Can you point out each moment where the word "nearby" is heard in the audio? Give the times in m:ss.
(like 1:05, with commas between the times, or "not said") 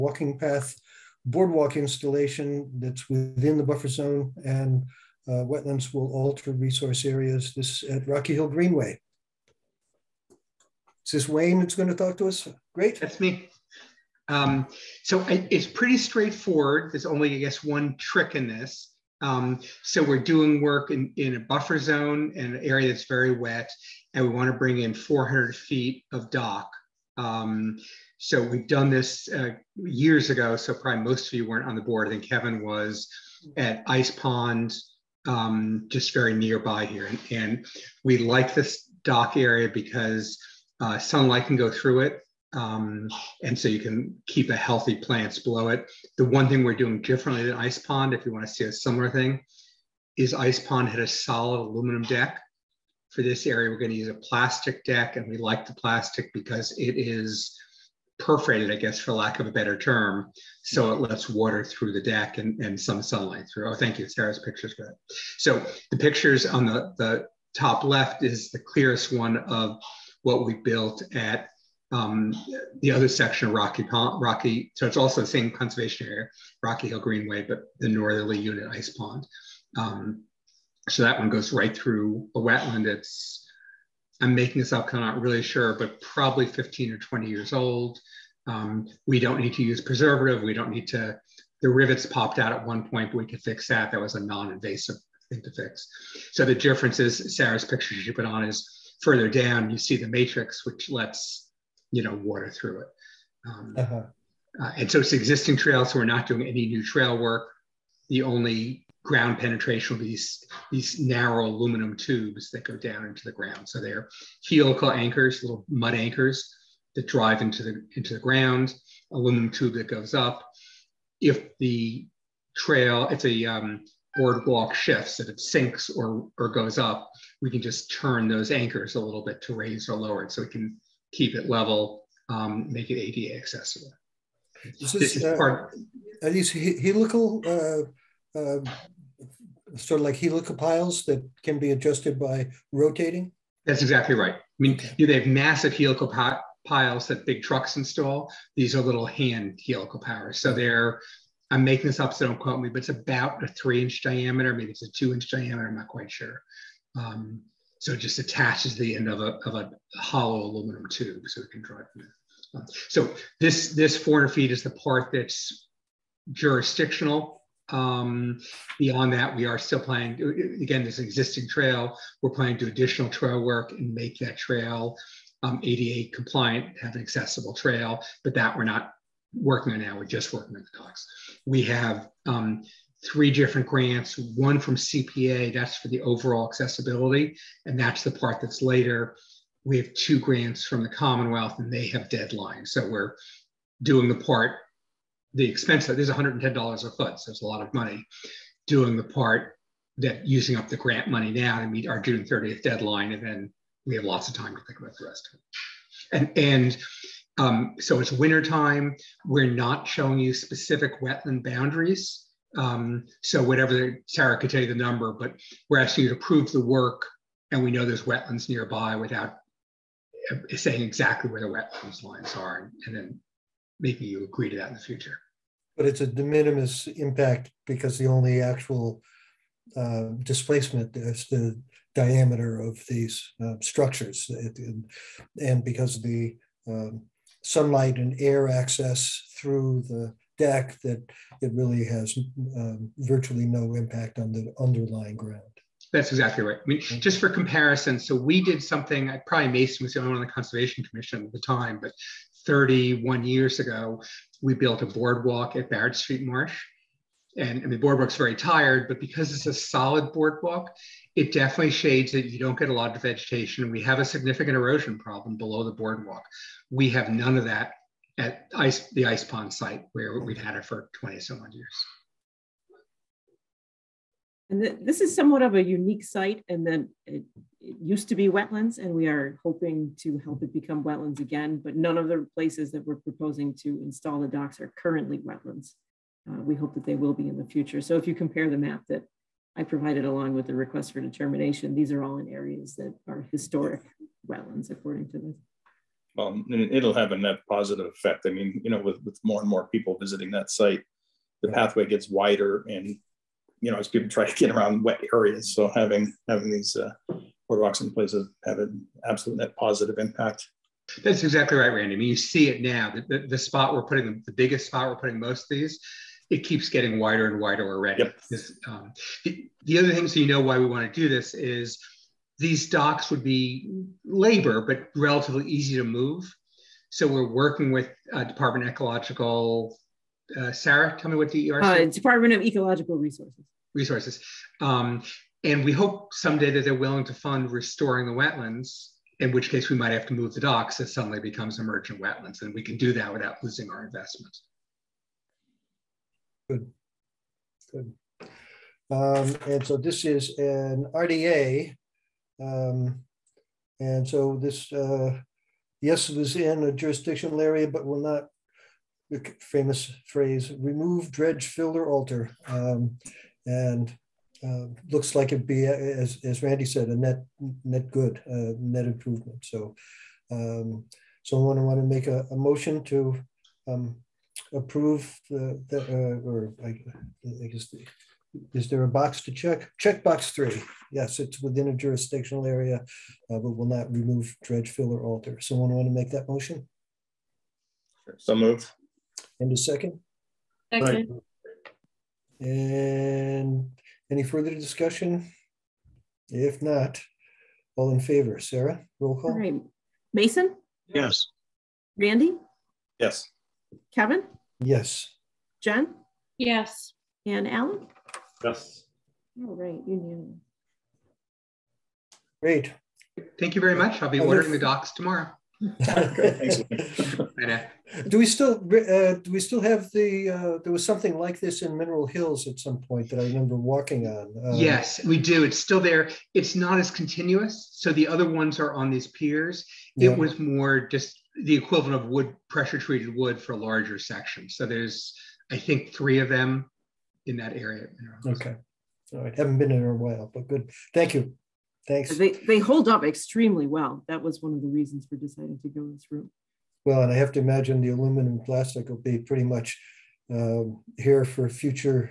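0:36, 3:38.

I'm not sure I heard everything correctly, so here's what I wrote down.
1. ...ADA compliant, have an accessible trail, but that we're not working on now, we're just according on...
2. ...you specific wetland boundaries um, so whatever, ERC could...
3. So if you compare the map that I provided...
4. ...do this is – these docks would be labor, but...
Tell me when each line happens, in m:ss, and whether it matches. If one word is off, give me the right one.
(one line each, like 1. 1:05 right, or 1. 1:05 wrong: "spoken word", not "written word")
1. 2:55 wrong: "working", not "according"
2. 3:30 wrong: "Sarah", not "ERC"
3. 4:47 right
4. 5:21 right.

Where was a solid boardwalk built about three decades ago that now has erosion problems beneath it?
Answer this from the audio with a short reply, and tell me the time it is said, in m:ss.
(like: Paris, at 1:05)
Barrett Street Marsh, at 4:15.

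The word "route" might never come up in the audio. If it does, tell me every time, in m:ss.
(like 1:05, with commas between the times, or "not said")
7:26.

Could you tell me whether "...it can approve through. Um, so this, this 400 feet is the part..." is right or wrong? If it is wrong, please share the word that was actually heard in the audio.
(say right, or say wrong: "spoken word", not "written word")
wrong: "drive", not "approve".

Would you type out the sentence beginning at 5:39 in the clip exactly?
In which case, we might have to move the docks.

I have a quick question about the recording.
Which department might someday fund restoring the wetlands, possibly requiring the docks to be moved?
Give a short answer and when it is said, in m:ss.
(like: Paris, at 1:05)
Department of Ecological Resources, at 5:31.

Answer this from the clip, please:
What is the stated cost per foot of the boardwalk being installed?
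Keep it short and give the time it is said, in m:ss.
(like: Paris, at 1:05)
$110, at 3:16.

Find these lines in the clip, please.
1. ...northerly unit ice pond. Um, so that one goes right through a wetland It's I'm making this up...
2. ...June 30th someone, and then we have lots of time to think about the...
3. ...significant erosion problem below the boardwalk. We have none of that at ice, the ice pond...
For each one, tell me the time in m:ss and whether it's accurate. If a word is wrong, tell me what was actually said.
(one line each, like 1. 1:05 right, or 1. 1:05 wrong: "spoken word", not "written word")
1. 1:17 right
2. 3:22 wrong: "deadline", not "someone"
3. 4:24 right.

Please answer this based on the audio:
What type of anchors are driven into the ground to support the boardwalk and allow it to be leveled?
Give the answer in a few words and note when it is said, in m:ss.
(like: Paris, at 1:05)
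Helical anchors, at 1:54.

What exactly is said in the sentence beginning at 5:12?
The, the, the spot we're putting, the biggest spot we're putting most of these, it keeps getting wider and wider already.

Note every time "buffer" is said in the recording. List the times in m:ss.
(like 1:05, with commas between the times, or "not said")
0:03, 0:21.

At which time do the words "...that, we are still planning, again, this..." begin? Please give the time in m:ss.
2:49.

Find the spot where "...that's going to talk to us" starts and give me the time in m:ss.
0:11.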